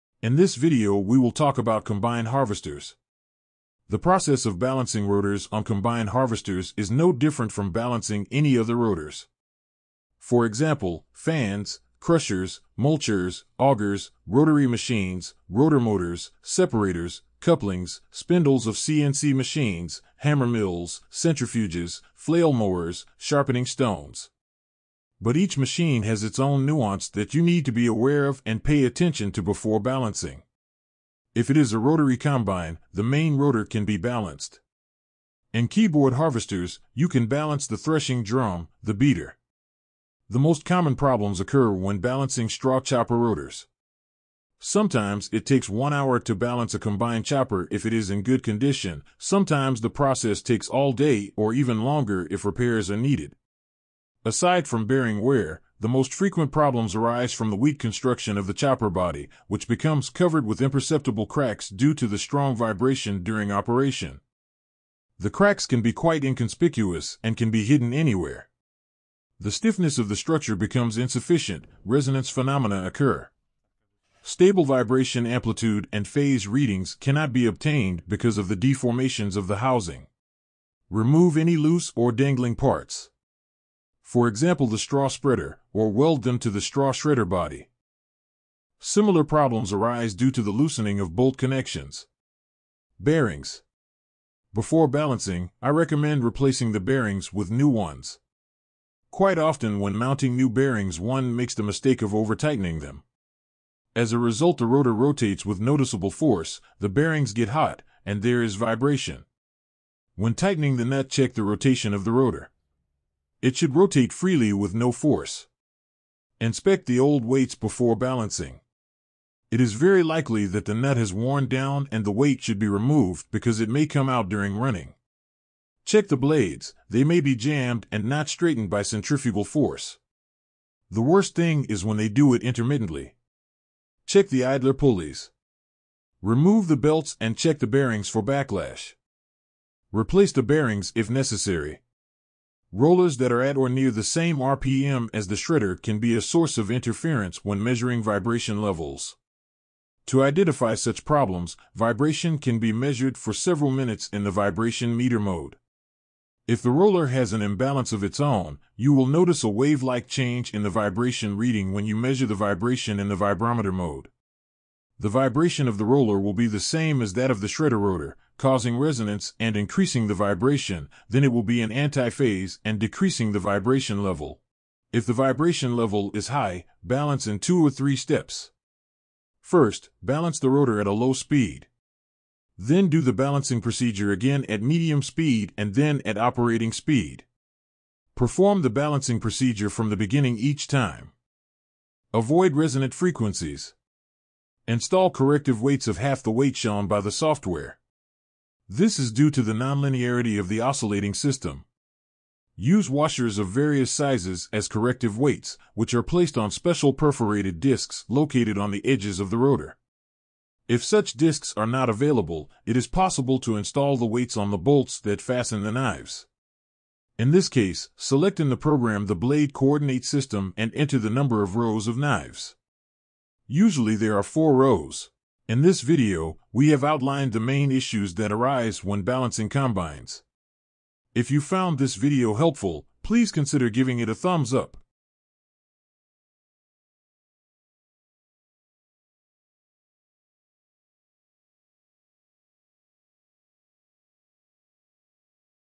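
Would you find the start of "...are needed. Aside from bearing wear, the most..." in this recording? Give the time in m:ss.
0:52.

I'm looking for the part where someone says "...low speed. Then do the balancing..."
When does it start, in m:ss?
3:00.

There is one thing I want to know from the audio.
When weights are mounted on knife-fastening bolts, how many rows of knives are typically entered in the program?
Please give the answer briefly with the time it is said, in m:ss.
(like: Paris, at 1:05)
4, at 3:44.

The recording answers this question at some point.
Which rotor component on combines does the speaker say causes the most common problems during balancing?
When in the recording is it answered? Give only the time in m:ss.
0:42.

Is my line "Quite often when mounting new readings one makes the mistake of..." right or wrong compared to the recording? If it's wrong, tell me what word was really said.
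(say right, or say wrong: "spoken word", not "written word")
wrong: "bearings", not "readings".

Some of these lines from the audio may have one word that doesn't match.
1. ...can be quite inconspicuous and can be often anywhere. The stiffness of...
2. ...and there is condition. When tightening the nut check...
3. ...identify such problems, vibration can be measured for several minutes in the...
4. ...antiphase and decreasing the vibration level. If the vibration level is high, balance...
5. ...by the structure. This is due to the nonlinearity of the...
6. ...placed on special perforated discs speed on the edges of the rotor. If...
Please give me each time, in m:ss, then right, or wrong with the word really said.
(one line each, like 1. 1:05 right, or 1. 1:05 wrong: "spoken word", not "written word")
1. 1:05 wrong: "hidden", not "often"
2. 1:48 wrong: "vibration", not "condition"
3. 2:30 right
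4. 2:51 right
5. 3:16 wrong: "software", not "structure"
6. 3:26 wrong: "located", not "speed".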